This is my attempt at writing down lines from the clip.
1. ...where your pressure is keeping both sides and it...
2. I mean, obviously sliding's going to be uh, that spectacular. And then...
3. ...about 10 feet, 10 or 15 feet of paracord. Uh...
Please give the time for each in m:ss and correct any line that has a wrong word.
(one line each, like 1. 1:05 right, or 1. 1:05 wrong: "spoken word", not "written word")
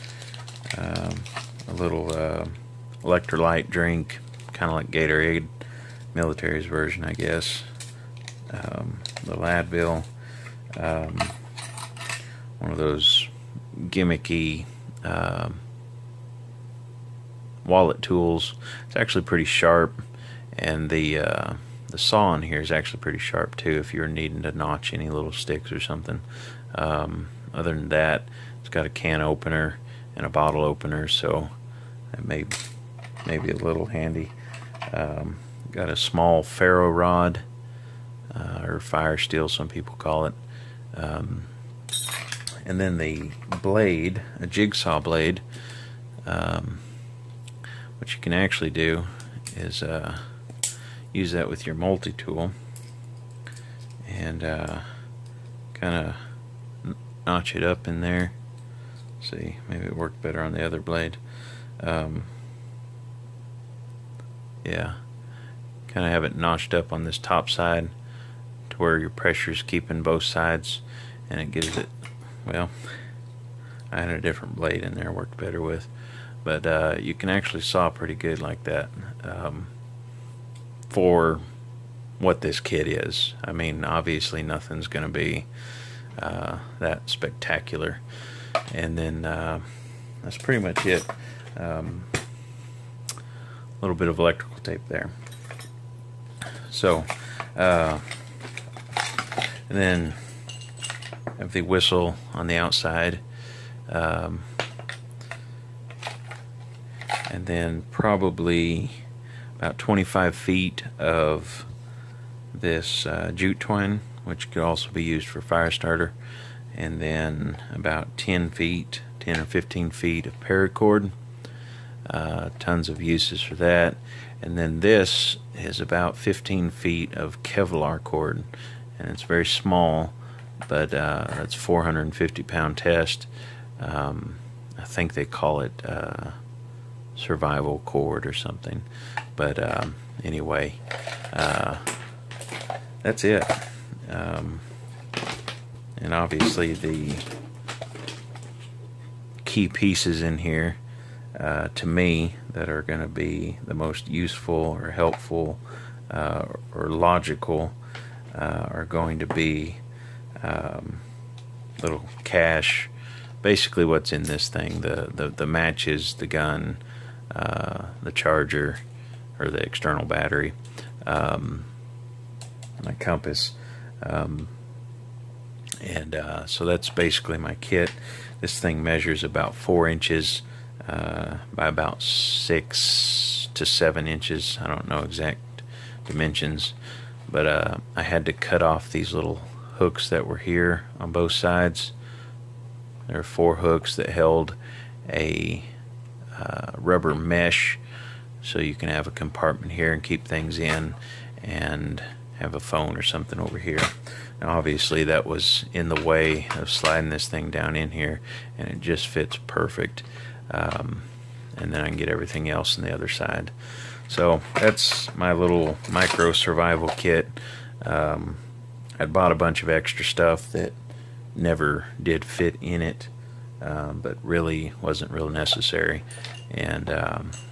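1. 1:08 right
2. 1:23 wrong: "nothing", not "sliding"
3. 1:57 right.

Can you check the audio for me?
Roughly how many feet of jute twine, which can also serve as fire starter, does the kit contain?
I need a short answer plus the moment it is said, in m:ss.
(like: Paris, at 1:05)
25 feet, at 1:49.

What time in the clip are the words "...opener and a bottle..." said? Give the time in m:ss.
0:29.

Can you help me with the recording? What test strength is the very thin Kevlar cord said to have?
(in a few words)
450 pound.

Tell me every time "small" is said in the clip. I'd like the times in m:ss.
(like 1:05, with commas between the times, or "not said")
0:35, 2:09.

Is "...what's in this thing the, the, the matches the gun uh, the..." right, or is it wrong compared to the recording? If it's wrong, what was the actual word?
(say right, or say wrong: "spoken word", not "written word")
right.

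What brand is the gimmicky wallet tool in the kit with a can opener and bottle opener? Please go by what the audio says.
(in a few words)
Ladville.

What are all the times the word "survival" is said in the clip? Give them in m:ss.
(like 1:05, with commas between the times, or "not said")
2:17, 3:36.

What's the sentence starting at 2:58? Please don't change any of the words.
This thing measures about four inches uh, by about six to seven inches.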